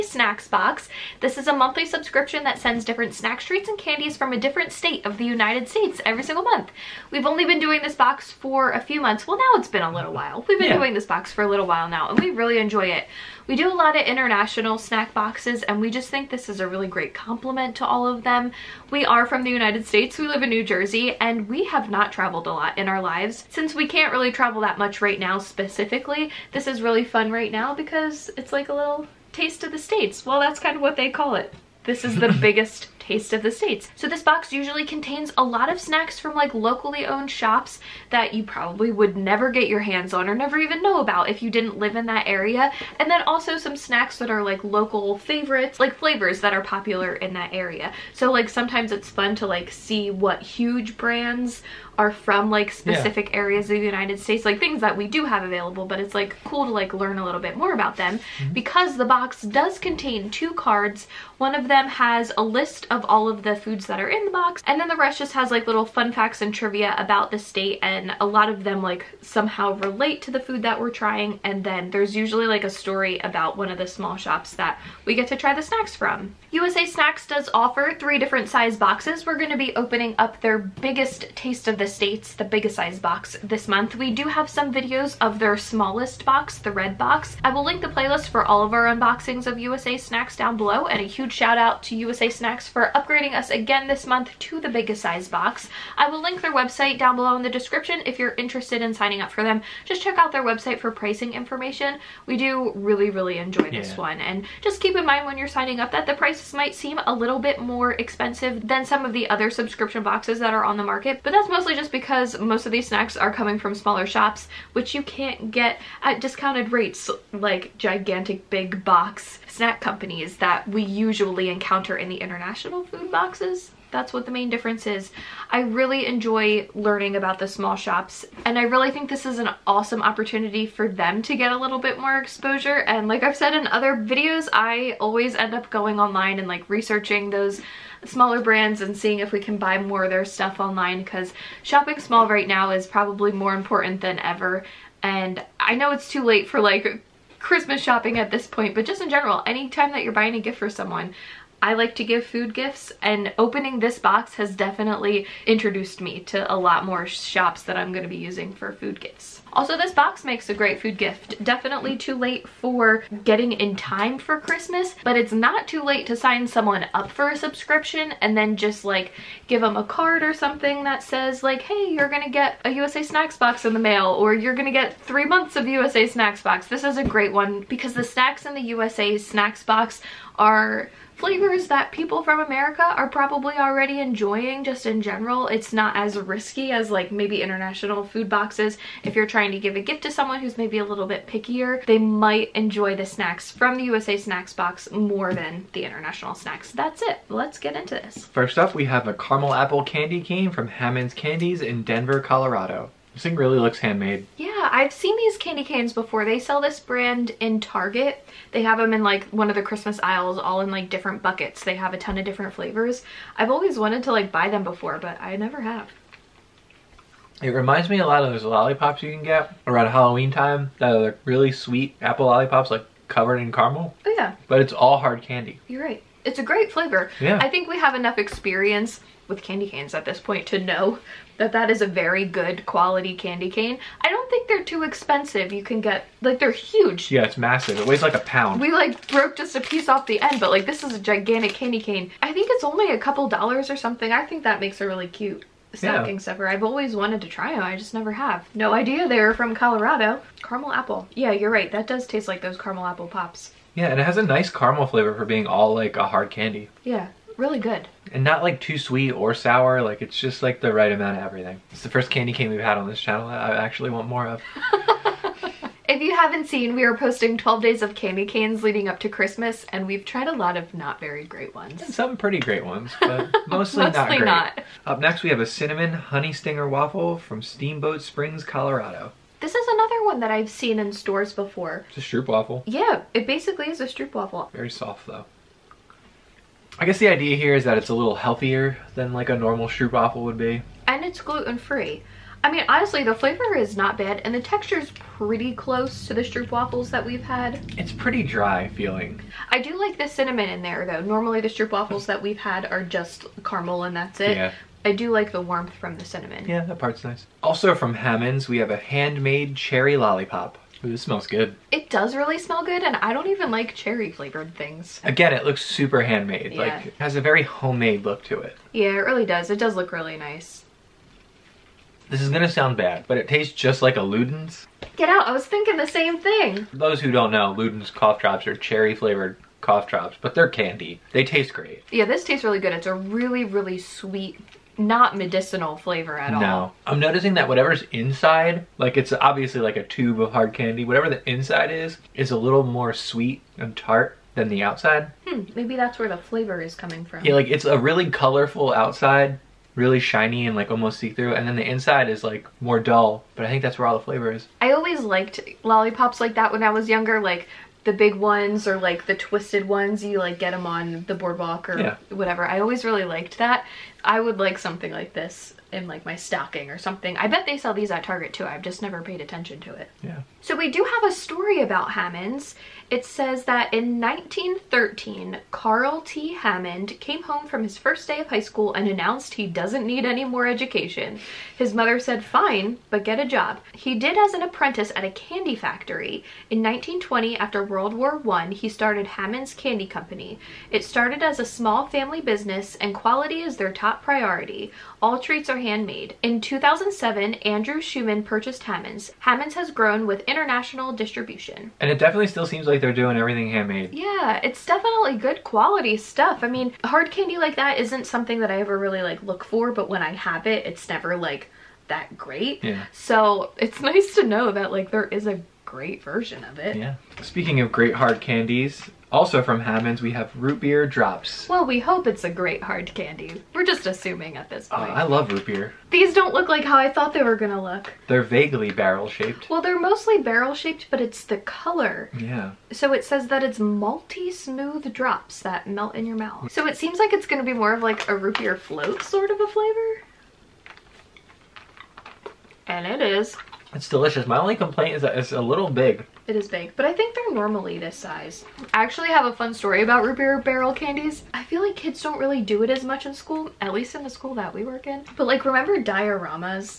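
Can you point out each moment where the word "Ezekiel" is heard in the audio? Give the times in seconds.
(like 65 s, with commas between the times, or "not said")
not said.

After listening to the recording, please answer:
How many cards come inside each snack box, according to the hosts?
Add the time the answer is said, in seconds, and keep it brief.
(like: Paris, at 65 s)
2, at 60 s.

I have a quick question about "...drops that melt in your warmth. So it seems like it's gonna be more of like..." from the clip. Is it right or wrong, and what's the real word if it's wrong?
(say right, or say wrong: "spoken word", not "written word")
wrong: "mouth", not "warmth".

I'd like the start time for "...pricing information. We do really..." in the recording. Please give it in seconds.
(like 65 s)
100 s.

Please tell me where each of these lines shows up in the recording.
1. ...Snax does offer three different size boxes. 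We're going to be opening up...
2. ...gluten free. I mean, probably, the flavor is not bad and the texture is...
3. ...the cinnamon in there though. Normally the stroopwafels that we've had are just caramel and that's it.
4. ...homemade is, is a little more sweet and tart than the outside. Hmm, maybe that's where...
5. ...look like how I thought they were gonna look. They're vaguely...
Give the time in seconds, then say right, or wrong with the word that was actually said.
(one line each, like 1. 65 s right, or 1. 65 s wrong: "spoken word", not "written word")
1. 76 s right
2. 291 s wrong: "honestly", not "probably"
3. 299 s right
4. 341 s wrong: "inside", not "homemade"
5. 426 s right.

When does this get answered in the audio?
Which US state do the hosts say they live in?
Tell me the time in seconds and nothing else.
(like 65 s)
20 s.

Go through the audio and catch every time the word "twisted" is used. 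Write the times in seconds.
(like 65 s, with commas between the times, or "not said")
359 s.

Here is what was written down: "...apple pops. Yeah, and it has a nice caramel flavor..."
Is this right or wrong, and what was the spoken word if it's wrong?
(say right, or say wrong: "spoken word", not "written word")
right.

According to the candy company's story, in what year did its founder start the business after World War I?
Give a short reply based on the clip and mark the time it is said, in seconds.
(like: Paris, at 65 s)
1920, at 386 s.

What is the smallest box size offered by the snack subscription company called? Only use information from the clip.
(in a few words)
the red box.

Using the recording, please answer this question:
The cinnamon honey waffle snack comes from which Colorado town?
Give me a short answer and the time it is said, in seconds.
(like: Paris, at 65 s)
Steamboat Springs, at 277 s.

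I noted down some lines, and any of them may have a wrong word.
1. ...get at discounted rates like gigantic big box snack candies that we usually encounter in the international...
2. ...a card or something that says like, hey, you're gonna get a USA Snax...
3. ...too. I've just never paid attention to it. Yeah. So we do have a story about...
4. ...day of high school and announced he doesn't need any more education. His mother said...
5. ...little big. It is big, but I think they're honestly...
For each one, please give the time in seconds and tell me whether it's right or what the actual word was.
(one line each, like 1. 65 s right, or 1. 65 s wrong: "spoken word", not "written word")
1. 115 s wrong: "companies", not "candies"
2. 169 s right
3. 368 s right
4. 378 s right
5. 445 s wrong: "normally", not "honestly".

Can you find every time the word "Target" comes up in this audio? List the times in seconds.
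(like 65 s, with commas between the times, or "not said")
207 s, 368 s.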